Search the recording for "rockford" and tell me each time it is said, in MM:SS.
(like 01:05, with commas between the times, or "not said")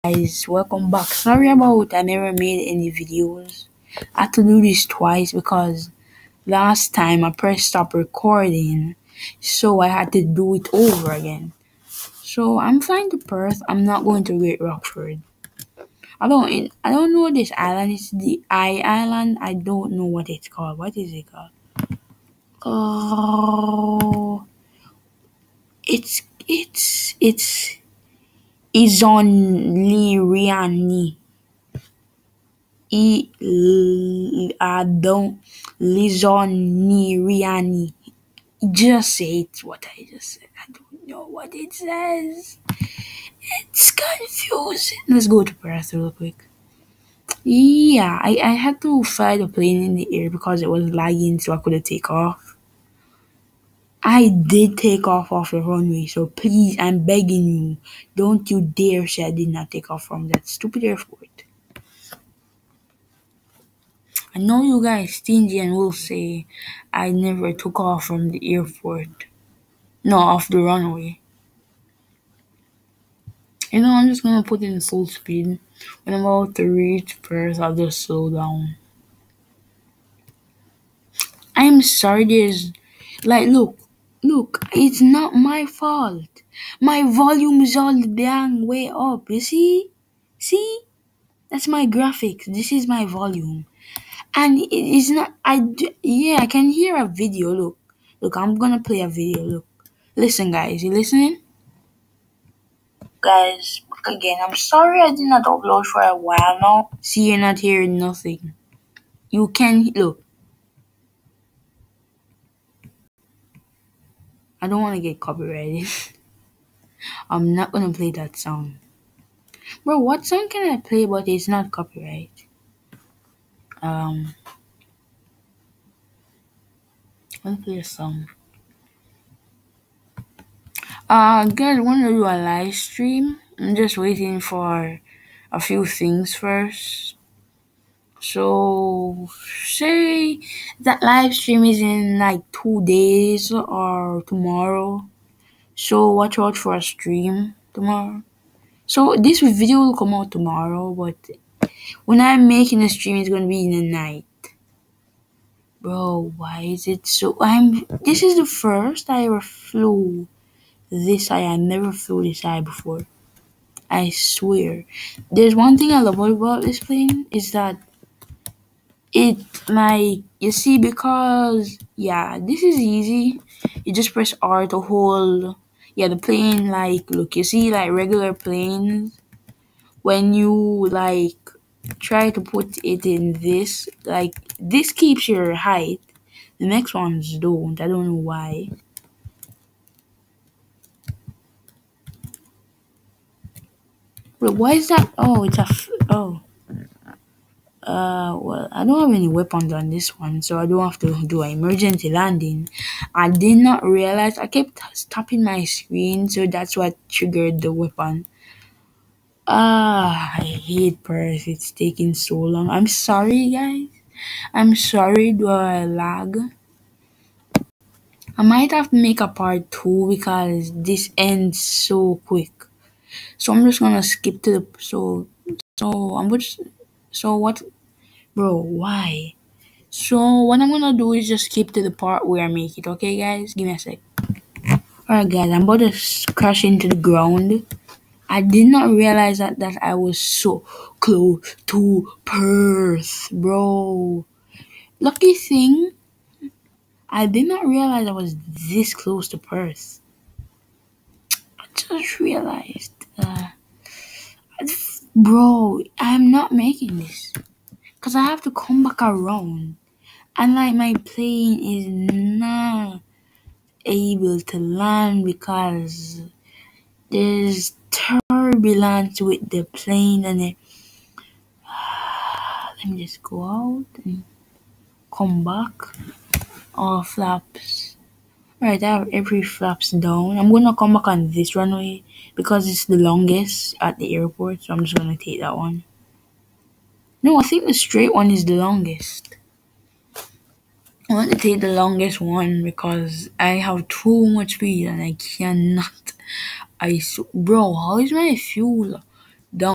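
00:14.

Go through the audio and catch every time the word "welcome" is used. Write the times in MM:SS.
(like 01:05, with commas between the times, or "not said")
00:00.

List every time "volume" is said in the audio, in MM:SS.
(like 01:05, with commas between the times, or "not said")
01:27, 01:33.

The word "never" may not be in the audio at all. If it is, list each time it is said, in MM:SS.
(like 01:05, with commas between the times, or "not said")
00:02, 01:07, 02:41.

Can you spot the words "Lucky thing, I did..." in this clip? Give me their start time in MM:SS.
04:05.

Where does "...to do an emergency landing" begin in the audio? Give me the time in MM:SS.
03:20.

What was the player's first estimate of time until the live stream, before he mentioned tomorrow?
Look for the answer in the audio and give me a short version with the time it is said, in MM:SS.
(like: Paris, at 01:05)
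two days, at 02:22.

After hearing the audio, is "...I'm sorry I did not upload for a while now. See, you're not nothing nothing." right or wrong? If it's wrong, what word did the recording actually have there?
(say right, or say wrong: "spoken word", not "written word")
wrong: "hearing", not "nothing".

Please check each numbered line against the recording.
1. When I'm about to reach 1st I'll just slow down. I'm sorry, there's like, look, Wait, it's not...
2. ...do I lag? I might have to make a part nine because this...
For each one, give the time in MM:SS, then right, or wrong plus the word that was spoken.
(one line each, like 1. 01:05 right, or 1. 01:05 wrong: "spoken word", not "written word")
1. 01:16 wrong: "Look", not "Wait"
2. 03:35 wrong: "two", not "nine".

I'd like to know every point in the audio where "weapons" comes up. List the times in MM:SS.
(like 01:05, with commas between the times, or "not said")
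03:19, 03:27.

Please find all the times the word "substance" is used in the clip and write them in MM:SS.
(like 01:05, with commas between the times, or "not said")
not said.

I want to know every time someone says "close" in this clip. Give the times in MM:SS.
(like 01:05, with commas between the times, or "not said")
04:01, 04:08.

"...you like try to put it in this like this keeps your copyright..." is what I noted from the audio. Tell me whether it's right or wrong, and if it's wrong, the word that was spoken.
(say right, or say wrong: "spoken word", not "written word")
wrong: "height", not "copyright".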